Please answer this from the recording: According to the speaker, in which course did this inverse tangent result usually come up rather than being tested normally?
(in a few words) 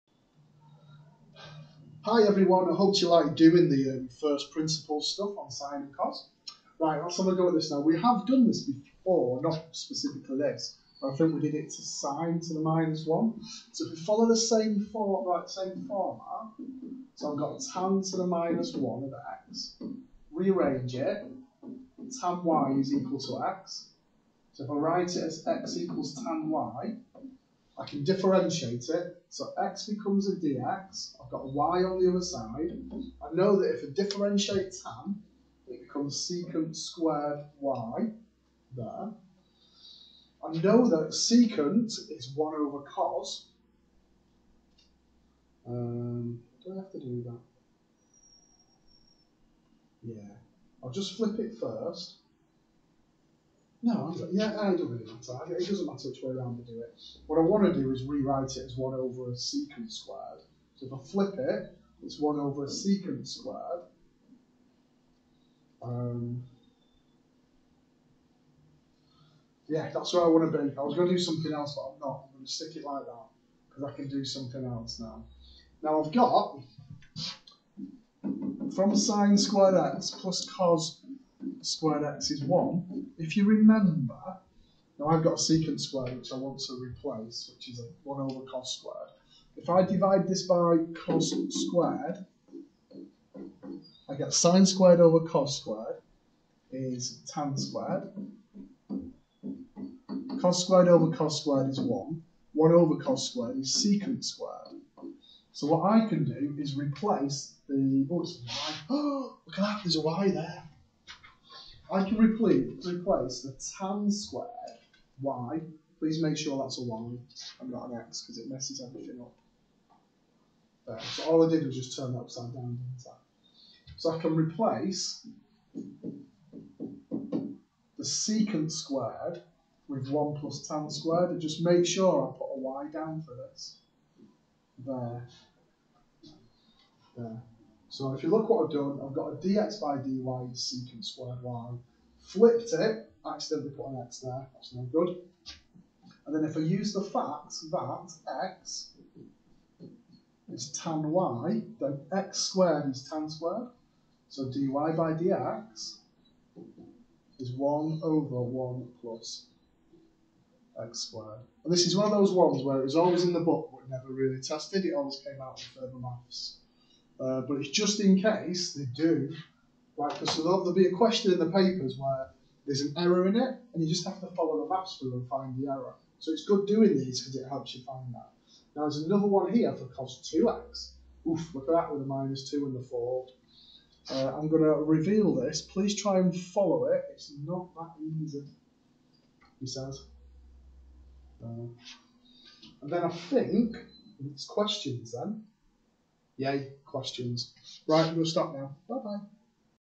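further maths.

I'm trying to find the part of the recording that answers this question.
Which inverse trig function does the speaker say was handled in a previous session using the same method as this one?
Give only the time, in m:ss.
0:11.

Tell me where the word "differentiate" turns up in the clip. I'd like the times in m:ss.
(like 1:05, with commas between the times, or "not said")
0:28, 0:33.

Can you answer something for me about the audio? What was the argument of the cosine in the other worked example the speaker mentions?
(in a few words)
cos 2x.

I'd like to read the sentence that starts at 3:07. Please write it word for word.
It's not that easy, he says.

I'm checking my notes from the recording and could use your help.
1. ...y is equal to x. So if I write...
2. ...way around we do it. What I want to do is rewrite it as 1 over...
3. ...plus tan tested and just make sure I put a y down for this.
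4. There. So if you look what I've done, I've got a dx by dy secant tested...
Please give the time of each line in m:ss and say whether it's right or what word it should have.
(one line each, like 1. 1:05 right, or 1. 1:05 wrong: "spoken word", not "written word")
1. 0:22 right
2. 0:56 right
3. 2:10 wrong: "squared", not "tested"
4. 2:17 wrong: "squared", not "tested".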